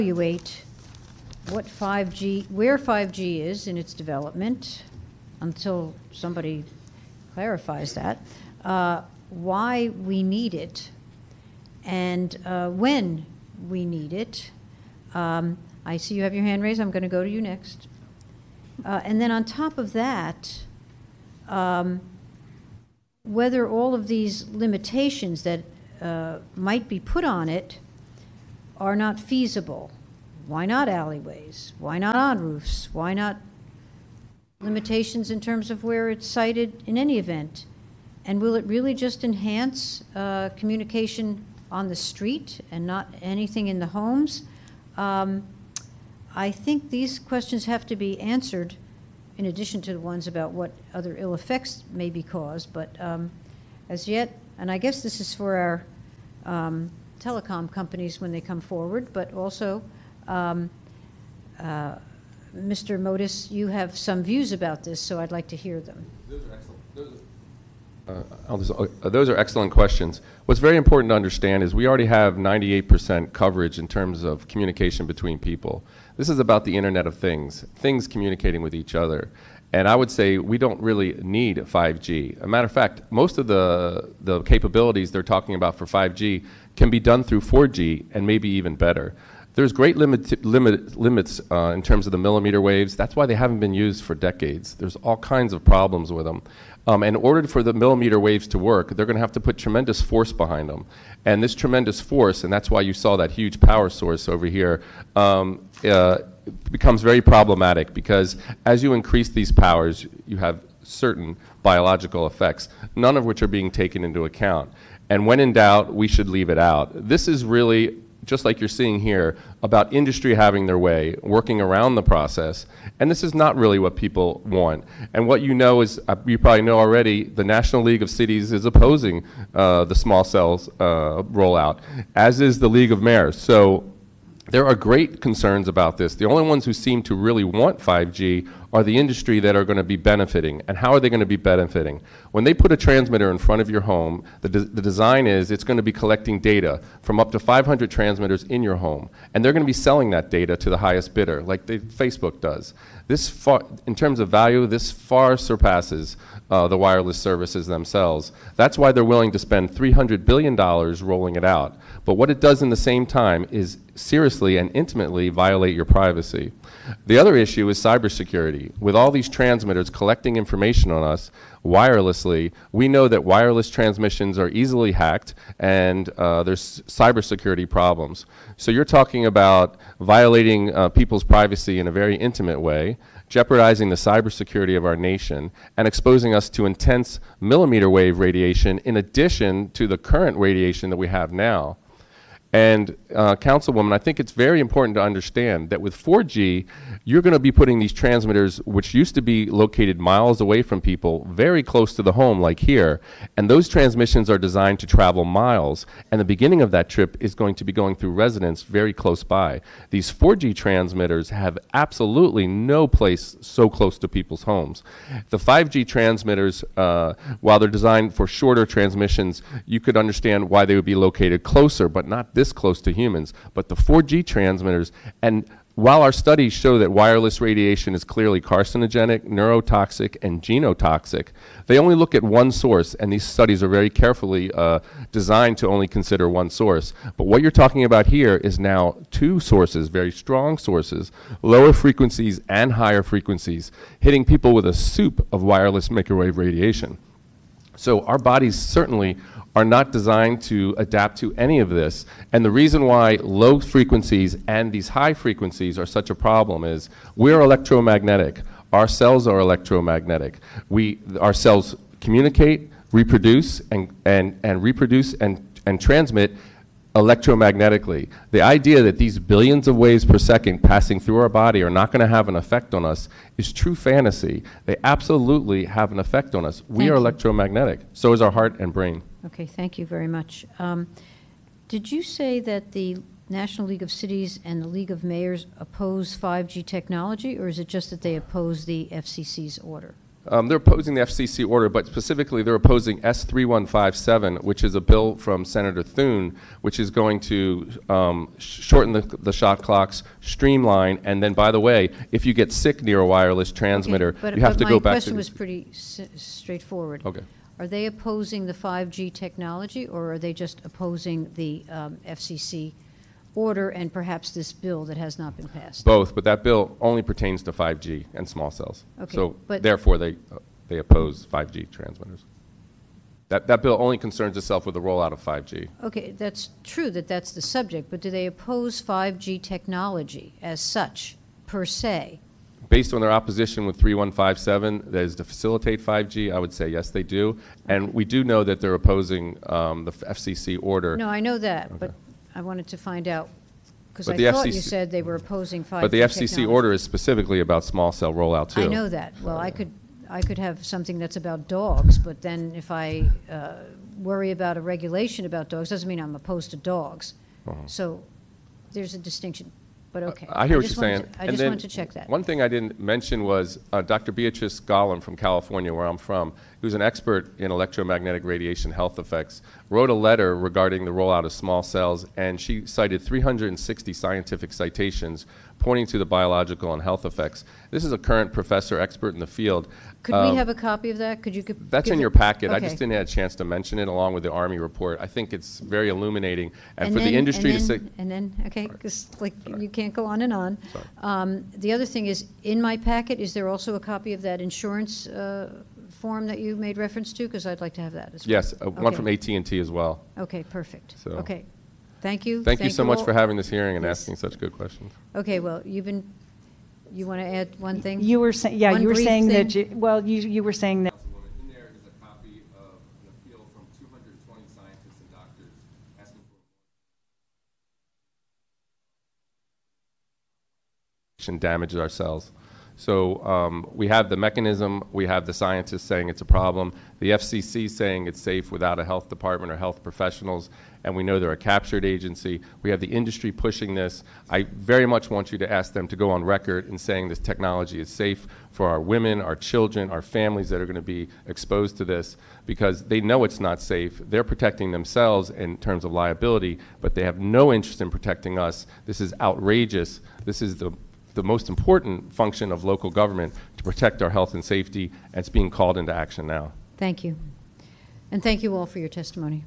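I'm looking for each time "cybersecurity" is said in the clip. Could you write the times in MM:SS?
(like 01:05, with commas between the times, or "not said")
02:47, 02:56, 03:03.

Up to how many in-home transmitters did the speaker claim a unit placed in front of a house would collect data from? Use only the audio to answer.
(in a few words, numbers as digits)
500.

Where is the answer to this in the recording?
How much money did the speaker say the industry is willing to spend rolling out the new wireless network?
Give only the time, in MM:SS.
02:39.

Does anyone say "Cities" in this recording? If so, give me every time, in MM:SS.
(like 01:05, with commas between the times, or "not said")
02:08, 04:43.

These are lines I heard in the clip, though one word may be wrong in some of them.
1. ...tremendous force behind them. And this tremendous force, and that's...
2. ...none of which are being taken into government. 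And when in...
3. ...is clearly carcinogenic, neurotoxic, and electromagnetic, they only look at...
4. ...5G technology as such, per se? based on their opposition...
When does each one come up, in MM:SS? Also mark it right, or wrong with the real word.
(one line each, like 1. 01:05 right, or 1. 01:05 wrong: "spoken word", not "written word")
1. 01:39 right
2. 01:52 wrong: "account", not "government"
3. 03:47 wrong: "genotoxic", not "electromagnetic"
4. 05:28 right.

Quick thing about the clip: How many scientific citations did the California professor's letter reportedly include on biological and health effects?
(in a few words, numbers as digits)
360.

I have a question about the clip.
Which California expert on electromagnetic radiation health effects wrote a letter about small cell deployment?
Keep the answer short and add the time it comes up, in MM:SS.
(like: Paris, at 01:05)
Beatrice Golomb, at 06:04.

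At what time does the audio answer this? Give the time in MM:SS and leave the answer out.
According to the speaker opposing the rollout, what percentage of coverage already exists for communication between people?
01:12.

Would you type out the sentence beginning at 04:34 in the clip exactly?
They absolutely have an effect on us.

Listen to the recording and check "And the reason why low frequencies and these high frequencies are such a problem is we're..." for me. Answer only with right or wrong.
right.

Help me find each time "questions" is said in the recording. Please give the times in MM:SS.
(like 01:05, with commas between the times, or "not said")
00:47, 01:09, 05:04, 06:44.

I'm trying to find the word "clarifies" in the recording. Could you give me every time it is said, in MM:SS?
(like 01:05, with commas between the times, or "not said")
00:07.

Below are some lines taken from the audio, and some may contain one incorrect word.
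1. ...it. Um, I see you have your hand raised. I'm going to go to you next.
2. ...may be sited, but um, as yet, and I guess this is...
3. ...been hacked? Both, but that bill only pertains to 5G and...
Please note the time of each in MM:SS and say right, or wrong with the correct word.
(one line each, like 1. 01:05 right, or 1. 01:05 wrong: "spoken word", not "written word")
1. 00:14 right
2. 00:51 wrong: "caused", not "sited"
3. 05:15 wrong: "passed", not "hacked".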